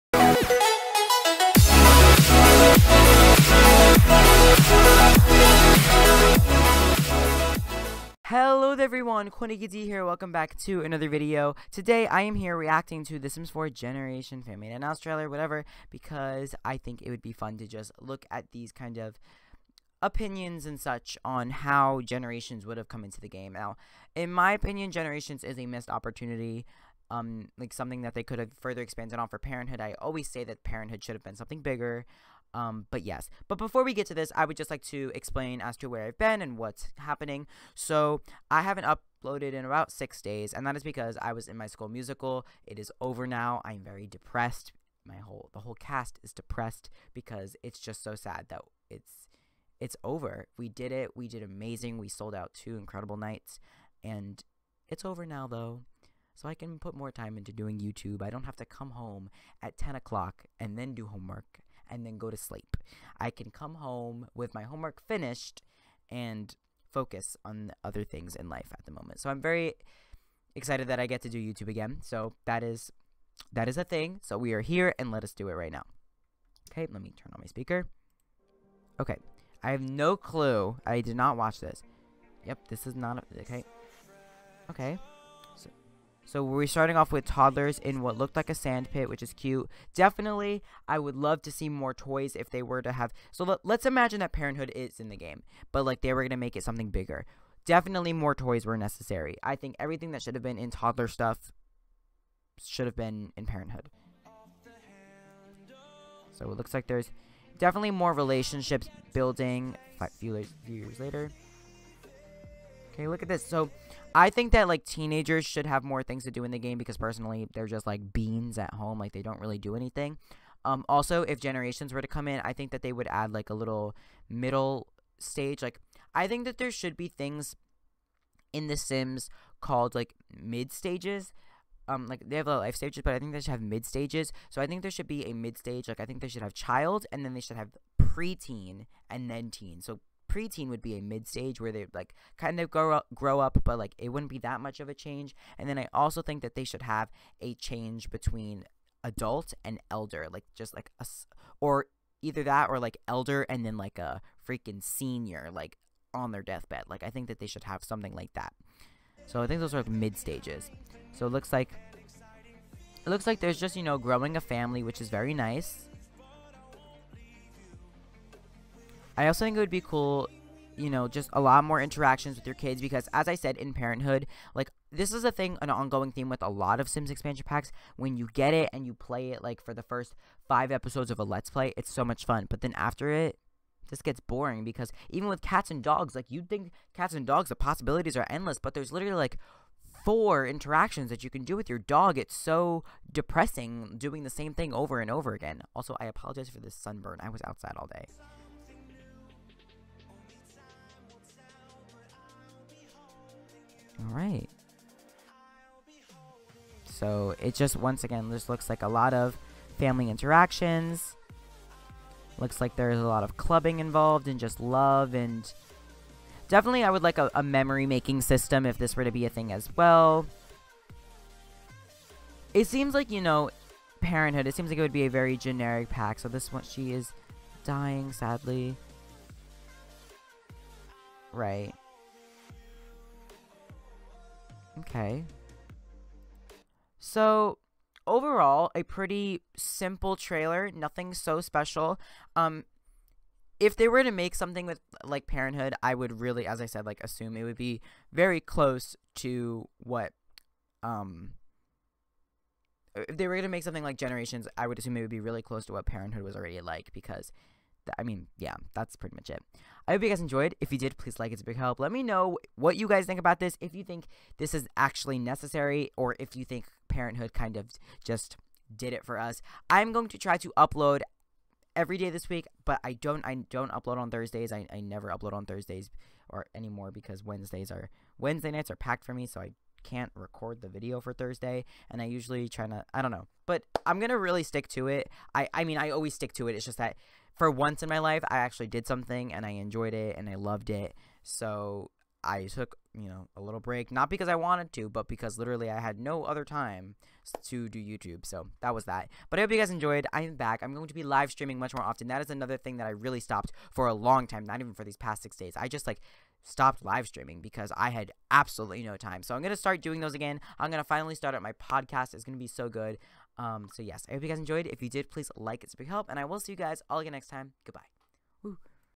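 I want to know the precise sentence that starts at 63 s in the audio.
I can come home with my homework finished and focus on other things in life at the moment.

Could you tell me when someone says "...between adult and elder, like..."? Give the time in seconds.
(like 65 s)
148 s.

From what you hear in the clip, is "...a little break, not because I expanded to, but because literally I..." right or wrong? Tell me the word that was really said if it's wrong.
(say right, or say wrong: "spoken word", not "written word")
wrong: "wanted", not "expanded".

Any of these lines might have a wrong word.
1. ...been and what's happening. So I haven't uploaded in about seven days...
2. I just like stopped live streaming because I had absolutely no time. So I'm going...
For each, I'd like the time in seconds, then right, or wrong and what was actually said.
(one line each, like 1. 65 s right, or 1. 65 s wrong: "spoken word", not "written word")
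1. 36 s wrong: "six", not "seven"
2. 305 s right.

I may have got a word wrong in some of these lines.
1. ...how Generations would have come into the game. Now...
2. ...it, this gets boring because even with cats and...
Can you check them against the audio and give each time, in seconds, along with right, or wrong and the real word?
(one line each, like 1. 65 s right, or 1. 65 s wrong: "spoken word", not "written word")
1. 21 s right
2. 183 s right.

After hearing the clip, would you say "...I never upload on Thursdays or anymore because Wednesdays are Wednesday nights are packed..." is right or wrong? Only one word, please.
right.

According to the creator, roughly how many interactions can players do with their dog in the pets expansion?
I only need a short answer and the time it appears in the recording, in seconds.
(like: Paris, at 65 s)
4, at 190 s.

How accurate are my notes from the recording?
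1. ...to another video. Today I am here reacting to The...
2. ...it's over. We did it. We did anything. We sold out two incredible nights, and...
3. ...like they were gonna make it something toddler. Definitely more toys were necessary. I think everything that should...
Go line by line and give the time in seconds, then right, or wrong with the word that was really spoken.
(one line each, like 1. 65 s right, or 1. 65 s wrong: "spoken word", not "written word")
1. 10 s right
2. 49 s wrong: "amazing", not "anything"
3. 95 s wrong: "bigger", not "toddler".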